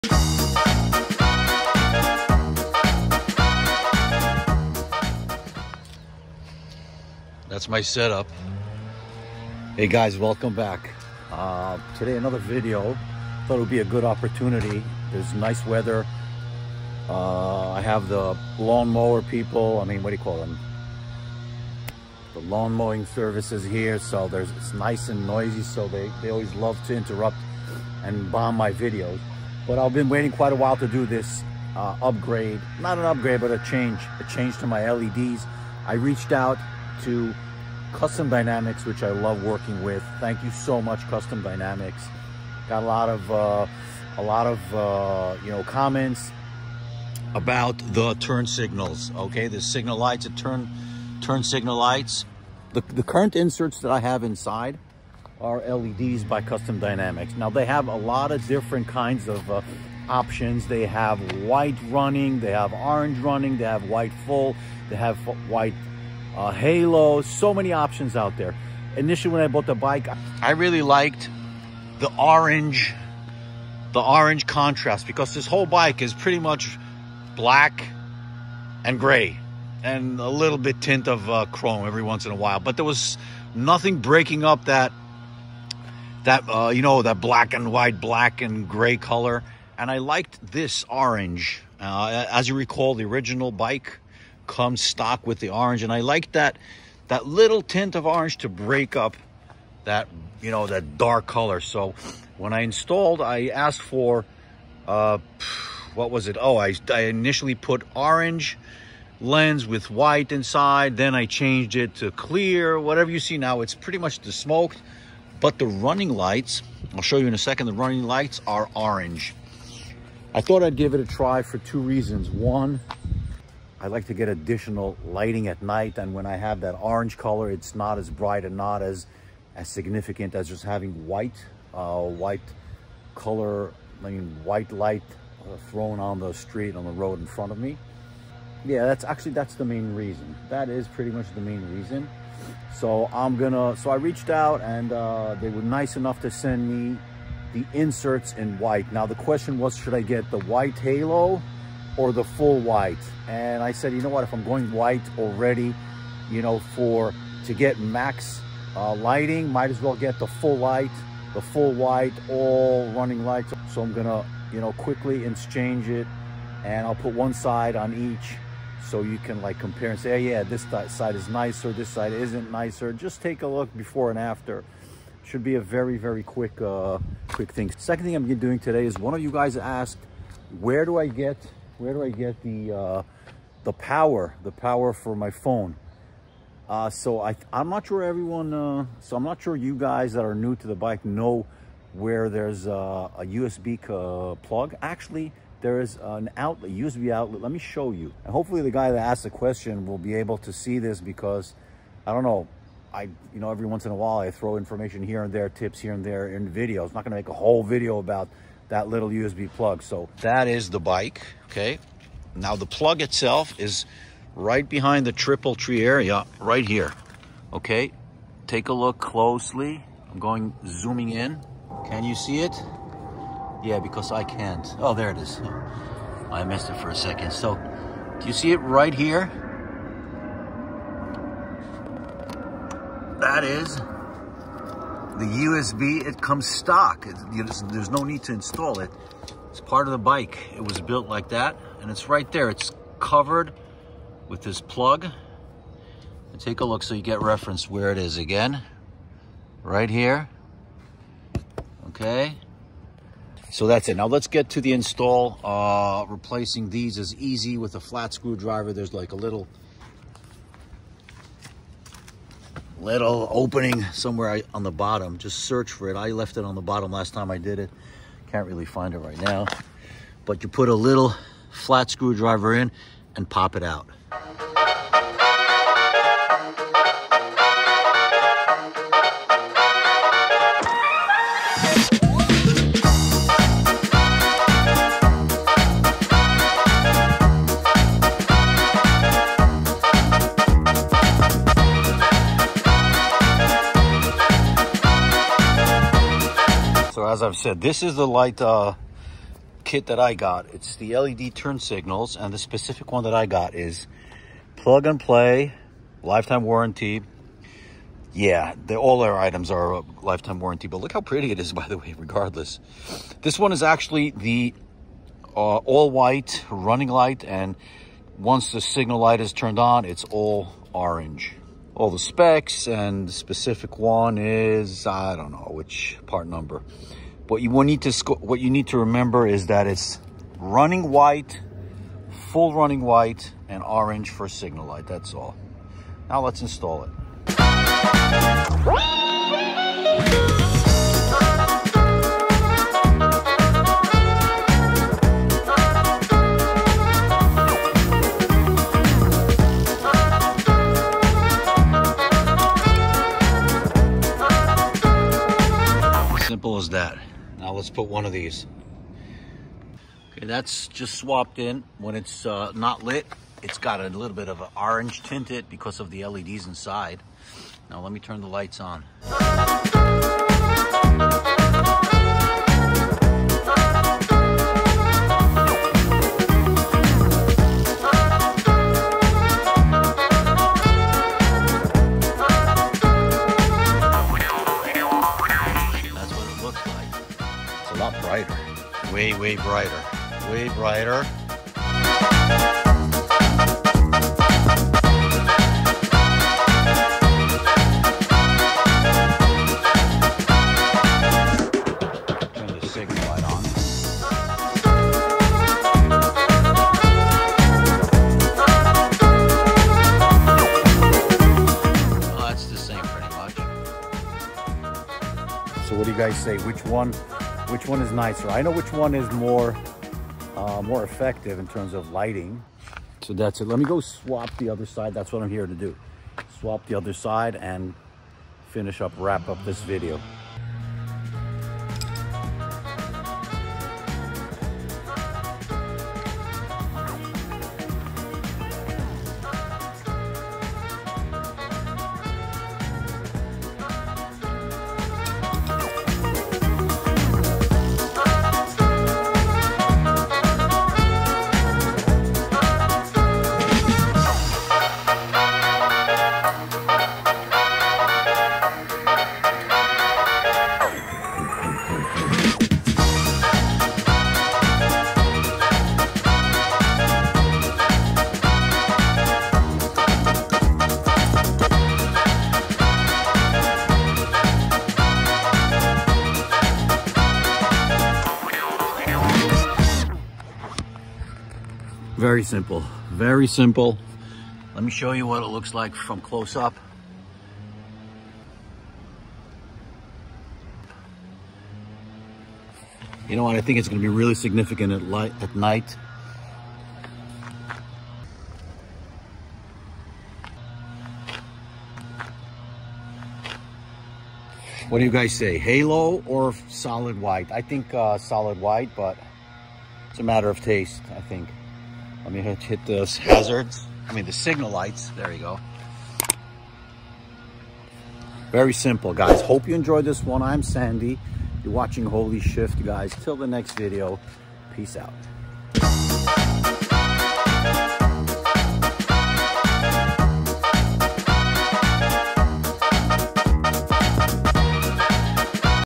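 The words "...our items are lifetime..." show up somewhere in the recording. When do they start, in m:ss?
5:09.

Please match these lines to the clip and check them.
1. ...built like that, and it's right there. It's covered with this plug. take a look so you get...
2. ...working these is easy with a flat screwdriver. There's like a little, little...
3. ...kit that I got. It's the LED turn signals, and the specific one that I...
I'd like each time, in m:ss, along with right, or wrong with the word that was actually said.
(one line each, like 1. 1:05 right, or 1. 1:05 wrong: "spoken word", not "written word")
1. 4:00 right
2. 4:16 wrong: "replacing", not "working"
3. 4:59 right.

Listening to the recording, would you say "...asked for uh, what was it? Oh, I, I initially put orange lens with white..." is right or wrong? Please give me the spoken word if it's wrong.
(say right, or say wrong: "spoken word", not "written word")
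right.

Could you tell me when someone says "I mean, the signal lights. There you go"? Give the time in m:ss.
8:33.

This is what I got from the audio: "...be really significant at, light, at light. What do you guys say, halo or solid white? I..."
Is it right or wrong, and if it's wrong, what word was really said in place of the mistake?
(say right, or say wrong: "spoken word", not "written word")
wrong: "night", not "light".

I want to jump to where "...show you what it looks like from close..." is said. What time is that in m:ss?
8:04.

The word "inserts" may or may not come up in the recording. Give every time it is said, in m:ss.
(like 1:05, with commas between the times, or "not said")
0:53, 2:27.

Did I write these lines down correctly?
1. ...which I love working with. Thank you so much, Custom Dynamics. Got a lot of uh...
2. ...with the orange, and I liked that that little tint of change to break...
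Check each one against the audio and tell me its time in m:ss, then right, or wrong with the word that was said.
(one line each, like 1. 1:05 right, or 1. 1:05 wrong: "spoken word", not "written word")
1. 0:38 right
2. 1:35 wrong: "orange", not "change".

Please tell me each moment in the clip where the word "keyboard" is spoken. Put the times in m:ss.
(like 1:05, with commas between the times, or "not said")
not said.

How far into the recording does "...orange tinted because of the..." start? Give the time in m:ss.
6:04.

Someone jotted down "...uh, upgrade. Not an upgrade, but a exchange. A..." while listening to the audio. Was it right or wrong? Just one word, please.
wrong.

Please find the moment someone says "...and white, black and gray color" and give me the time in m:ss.
1:27.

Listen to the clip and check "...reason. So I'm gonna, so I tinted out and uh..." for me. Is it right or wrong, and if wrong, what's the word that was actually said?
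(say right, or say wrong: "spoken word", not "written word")
wrong: "reached", not "tinted".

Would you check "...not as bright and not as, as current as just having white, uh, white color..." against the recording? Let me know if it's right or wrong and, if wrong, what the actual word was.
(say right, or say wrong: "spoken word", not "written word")
wrong: "significant", not "current".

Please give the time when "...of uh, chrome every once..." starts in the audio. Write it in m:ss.
1:21.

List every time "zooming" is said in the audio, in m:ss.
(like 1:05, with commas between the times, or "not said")
3:40.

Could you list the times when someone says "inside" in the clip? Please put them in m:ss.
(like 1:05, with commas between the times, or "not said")
0:54, 1:50, 6:06.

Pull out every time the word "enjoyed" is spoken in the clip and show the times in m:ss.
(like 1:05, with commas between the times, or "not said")
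8:39.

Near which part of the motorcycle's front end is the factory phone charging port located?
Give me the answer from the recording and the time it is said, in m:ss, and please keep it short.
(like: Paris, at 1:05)
triple tree, at 3:35.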